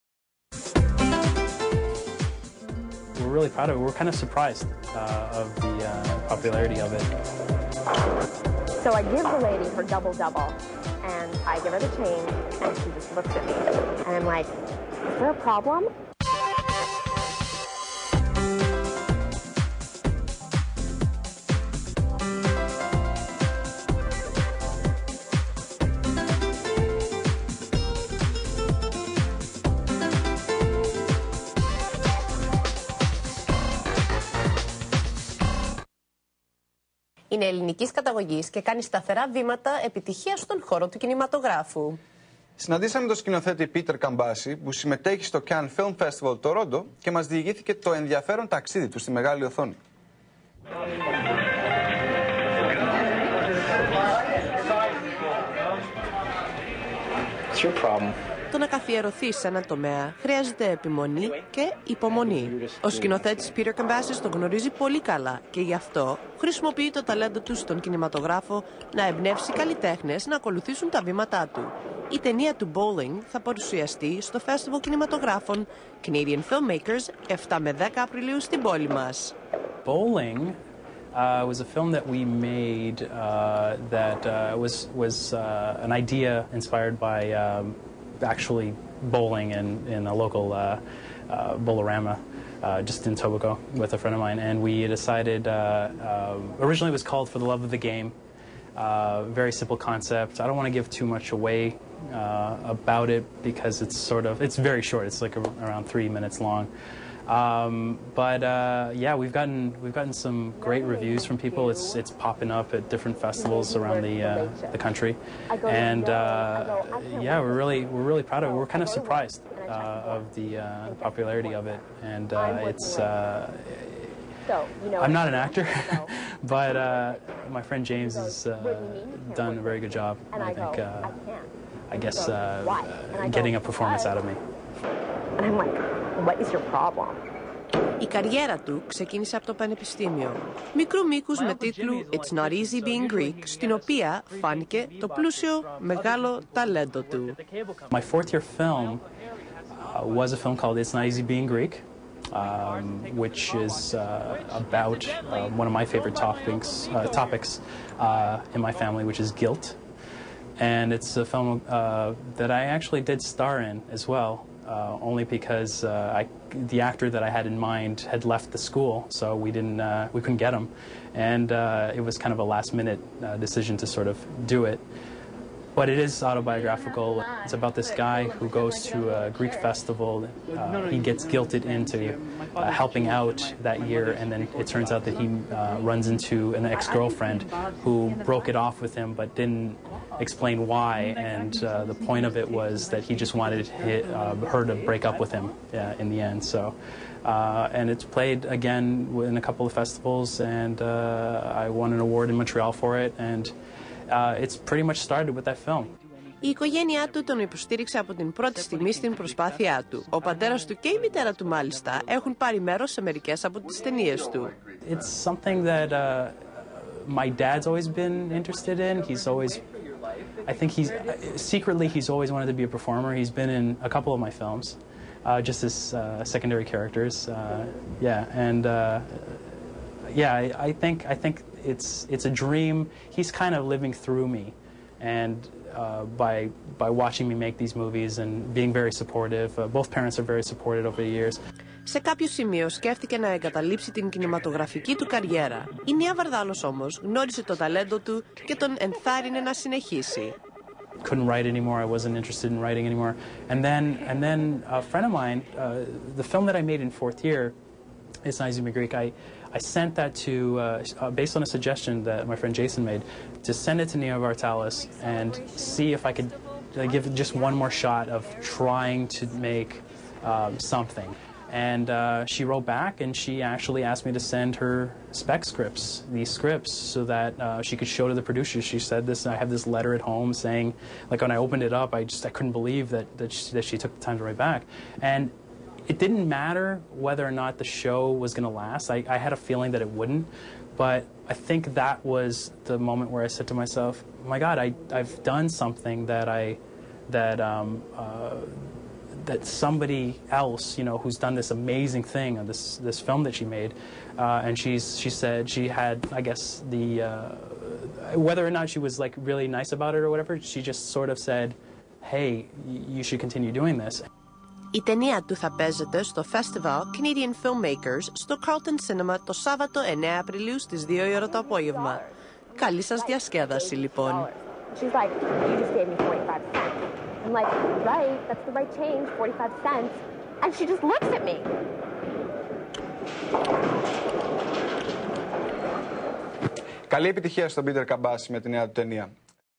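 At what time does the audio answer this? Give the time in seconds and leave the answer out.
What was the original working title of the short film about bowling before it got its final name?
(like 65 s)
97 s.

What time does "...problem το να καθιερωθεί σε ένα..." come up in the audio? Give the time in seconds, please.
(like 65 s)
57 s.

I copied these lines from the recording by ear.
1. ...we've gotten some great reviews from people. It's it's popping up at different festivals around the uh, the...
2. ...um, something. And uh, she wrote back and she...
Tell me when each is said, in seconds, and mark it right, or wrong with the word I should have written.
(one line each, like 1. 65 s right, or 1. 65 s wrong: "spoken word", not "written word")
1. 109 s right
2. 270 s right.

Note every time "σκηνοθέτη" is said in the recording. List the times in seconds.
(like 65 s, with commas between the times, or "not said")
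43 s, 62 s.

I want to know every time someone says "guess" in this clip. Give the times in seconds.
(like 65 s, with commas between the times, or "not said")
131 s, 306 s.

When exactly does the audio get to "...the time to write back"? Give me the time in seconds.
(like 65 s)
283 s.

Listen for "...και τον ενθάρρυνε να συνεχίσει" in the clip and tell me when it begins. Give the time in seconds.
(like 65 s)
248 s.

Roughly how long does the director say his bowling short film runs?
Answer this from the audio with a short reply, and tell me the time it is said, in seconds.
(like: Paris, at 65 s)
3 minutes, at 105 s.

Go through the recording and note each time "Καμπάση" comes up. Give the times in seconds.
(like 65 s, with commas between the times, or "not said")
43 s, 63 s, 337 s.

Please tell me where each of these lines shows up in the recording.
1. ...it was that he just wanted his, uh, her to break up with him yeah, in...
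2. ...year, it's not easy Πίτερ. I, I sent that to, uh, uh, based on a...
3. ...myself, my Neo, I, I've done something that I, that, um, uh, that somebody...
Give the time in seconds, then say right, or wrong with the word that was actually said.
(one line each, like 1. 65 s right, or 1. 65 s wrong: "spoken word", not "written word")
1. 192 s right
2. 257 s wrong: "Greek", not "Πίτερ"
3. 293 s wrong: "God", not "Neo".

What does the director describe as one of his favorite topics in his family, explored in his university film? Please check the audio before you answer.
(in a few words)
Guilt.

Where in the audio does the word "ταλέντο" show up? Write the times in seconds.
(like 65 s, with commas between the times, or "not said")
67 s, 146 s, 247 s.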